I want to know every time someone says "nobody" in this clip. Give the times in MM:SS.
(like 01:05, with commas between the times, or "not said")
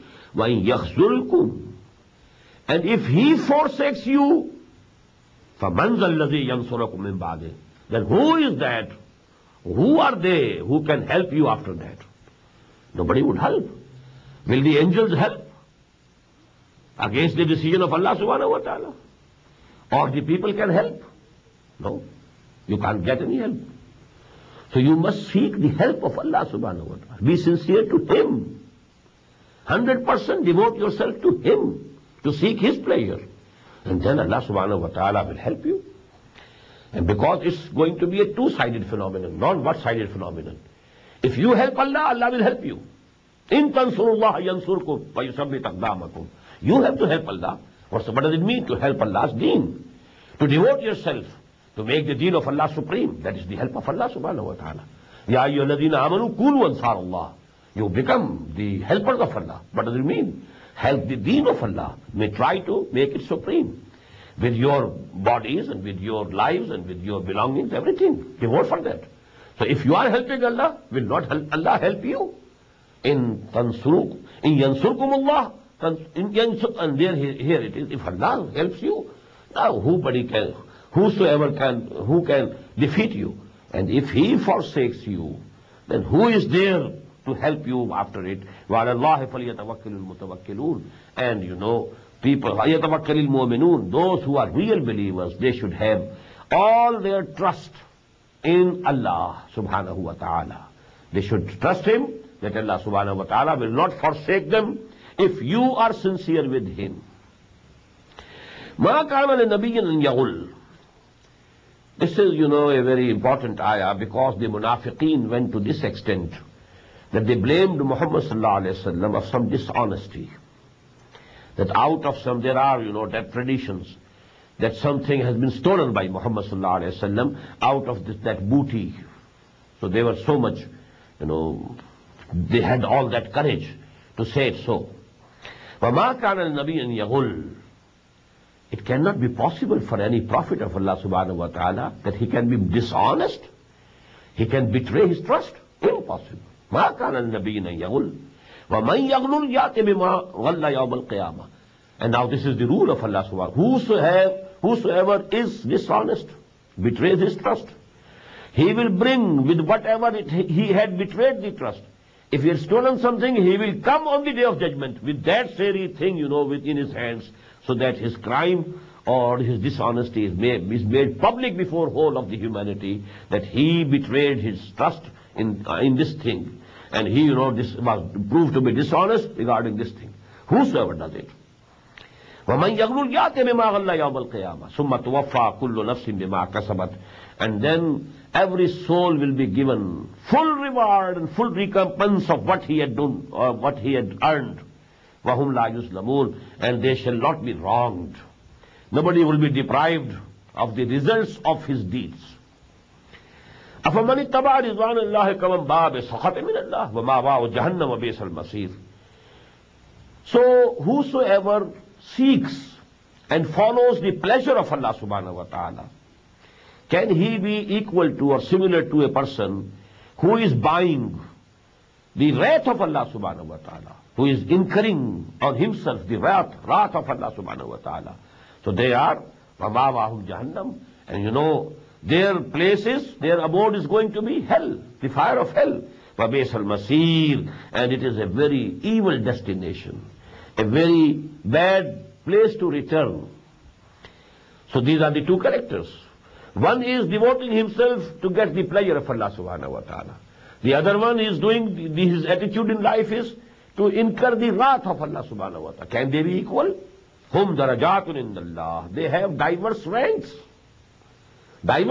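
00:12, 01:19, 03:18.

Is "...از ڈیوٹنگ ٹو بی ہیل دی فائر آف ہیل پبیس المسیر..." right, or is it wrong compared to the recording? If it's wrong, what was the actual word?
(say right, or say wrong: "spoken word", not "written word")
wrong: "گوئنگ", not "ڈیوٹنگ".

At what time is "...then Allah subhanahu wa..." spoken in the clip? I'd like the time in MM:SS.
00:34.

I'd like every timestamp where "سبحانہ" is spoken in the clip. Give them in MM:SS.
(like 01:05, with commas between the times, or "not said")
03:35, 03:43, 03:47, 04:09, 04:15.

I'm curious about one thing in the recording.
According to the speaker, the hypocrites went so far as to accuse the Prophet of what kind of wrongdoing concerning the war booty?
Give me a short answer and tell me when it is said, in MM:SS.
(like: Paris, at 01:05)
dishonesty, at 01:59.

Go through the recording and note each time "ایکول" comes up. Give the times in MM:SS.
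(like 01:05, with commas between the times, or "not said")
03:37, 04:16.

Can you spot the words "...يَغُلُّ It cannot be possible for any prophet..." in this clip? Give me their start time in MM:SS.
02:16.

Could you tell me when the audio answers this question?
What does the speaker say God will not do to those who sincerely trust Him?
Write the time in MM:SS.
01:44.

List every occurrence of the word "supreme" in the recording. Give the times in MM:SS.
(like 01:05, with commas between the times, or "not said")
00:52, 01:03.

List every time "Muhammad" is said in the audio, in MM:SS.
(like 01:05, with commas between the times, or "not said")
01:57, 02:06.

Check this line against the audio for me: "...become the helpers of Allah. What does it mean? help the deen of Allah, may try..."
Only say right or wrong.
right.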